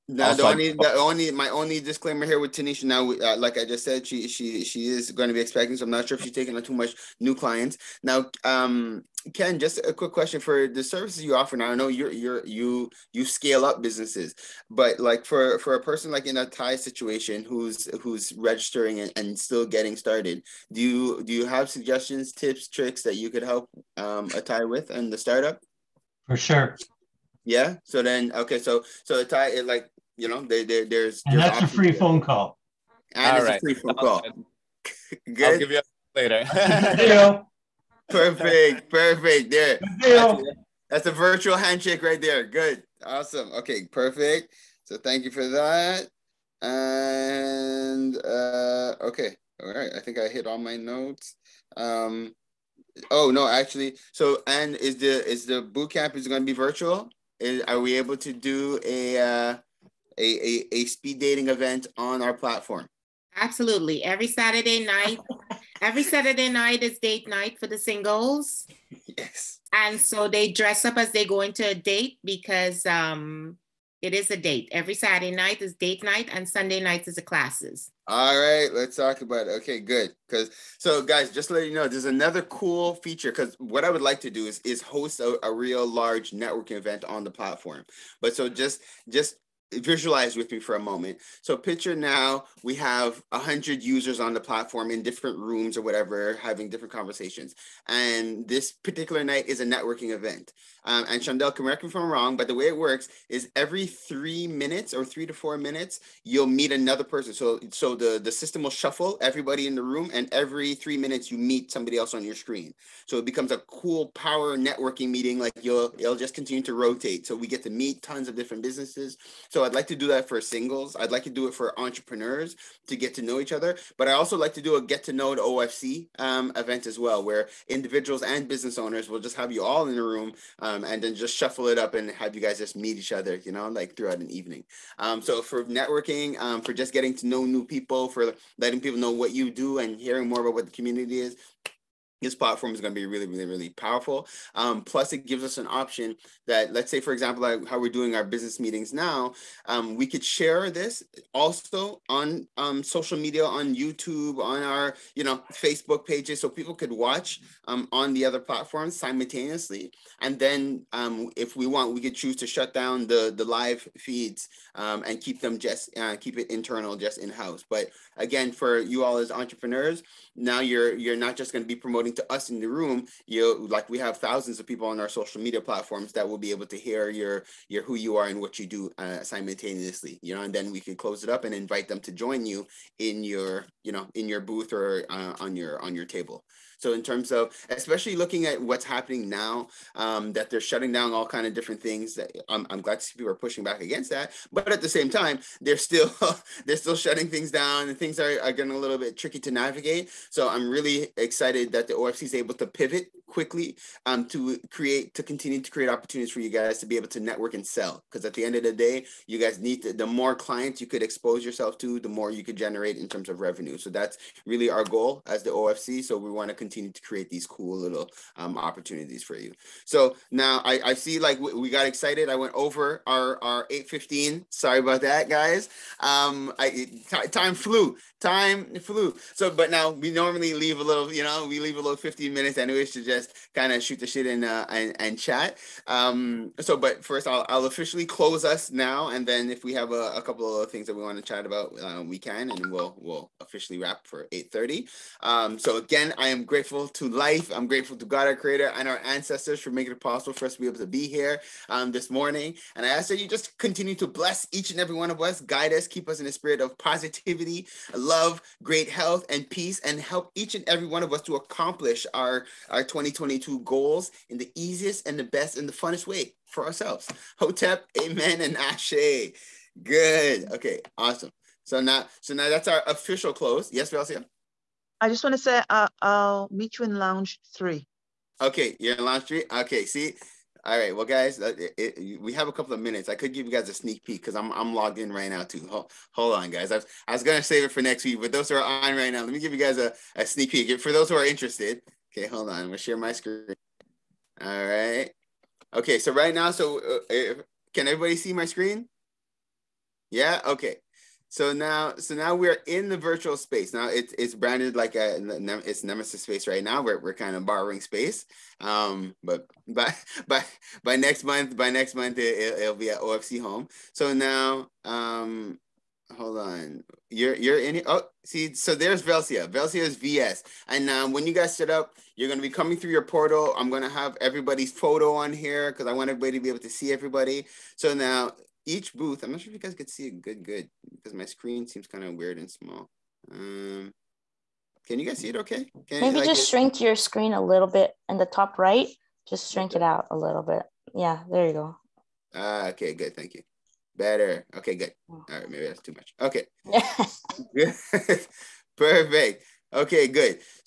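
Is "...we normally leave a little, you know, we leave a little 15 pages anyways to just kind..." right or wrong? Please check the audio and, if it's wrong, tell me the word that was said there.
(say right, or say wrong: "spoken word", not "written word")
wrong: "minutes", not "pages".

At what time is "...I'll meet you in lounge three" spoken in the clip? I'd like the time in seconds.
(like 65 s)
276 s.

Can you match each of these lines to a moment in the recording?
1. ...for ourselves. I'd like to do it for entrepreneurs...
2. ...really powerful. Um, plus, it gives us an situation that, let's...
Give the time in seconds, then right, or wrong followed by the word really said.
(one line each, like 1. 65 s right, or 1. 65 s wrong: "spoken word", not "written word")
1. 120 s wrong: "singles", not "ourselves"
2. 143 s wrong: "option", not "situation".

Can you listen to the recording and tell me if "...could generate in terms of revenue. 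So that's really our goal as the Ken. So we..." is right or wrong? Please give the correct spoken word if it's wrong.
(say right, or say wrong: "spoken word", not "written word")
wrong: "OFC", not "Ken".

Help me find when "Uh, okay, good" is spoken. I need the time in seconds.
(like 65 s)
342 s.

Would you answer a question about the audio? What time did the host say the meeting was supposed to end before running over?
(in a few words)
8.15.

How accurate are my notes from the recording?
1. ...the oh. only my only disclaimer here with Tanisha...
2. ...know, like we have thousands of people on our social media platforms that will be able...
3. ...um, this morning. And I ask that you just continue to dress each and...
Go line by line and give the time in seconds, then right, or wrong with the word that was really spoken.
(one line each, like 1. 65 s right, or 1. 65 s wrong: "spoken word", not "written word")
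1. 0 s right
2. 173 s right
3. 251 s wrong: "bless", not "dress".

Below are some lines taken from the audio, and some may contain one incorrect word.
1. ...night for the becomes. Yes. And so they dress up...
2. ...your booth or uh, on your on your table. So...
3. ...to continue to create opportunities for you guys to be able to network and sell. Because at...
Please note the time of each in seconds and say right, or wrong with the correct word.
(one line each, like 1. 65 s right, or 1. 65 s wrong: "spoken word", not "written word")
1. 67 s wrong: "singles", not "becomes"
2. 184 s right
3. 205 s right.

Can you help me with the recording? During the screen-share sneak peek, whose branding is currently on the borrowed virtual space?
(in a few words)
Nemesis.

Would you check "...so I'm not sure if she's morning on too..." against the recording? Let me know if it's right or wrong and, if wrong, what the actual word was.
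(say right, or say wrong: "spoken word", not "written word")
wrong: "taking", not "morning".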